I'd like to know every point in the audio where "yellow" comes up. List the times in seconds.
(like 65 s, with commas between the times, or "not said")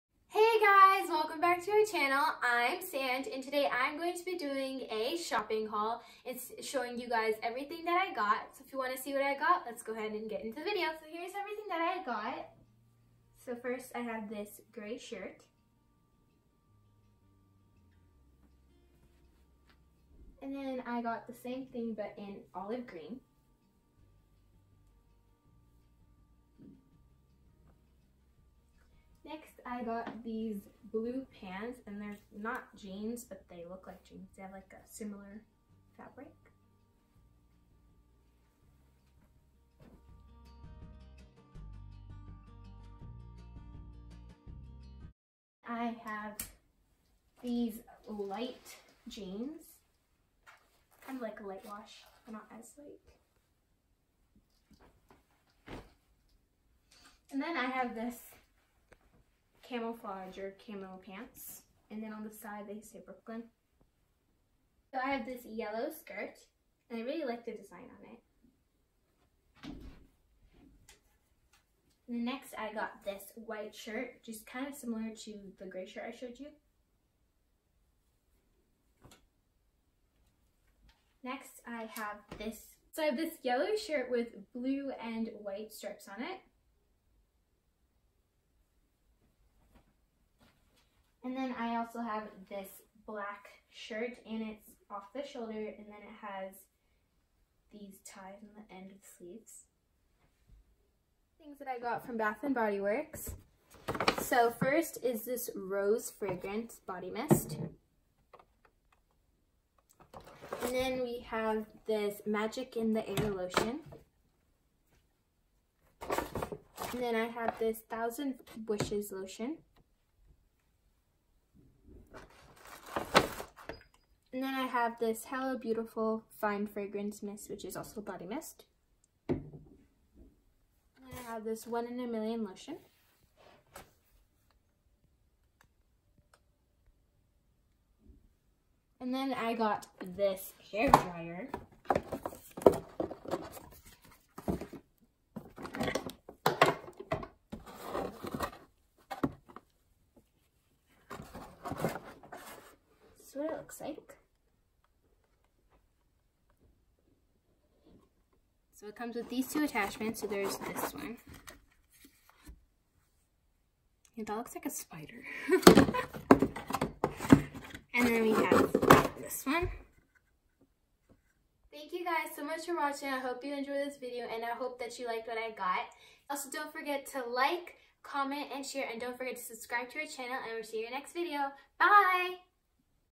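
65 s, 83 s.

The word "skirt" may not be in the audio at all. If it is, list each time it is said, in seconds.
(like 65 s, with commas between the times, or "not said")
65 s.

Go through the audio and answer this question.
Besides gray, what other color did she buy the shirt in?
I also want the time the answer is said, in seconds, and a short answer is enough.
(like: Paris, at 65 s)
Olive green, at 22 s.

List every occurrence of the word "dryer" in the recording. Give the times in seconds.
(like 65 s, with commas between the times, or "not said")
140 s.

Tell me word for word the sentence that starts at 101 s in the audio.
Things that I got from Bath & Body Works.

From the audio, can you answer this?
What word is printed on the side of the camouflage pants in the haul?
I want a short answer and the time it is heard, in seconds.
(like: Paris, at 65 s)
Brooklyn, at 63 s.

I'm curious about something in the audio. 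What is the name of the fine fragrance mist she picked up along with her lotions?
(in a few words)
Hello Beautiful.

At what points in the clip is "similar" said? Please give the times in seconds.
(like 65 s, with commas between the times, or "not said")
34 s, 74 s.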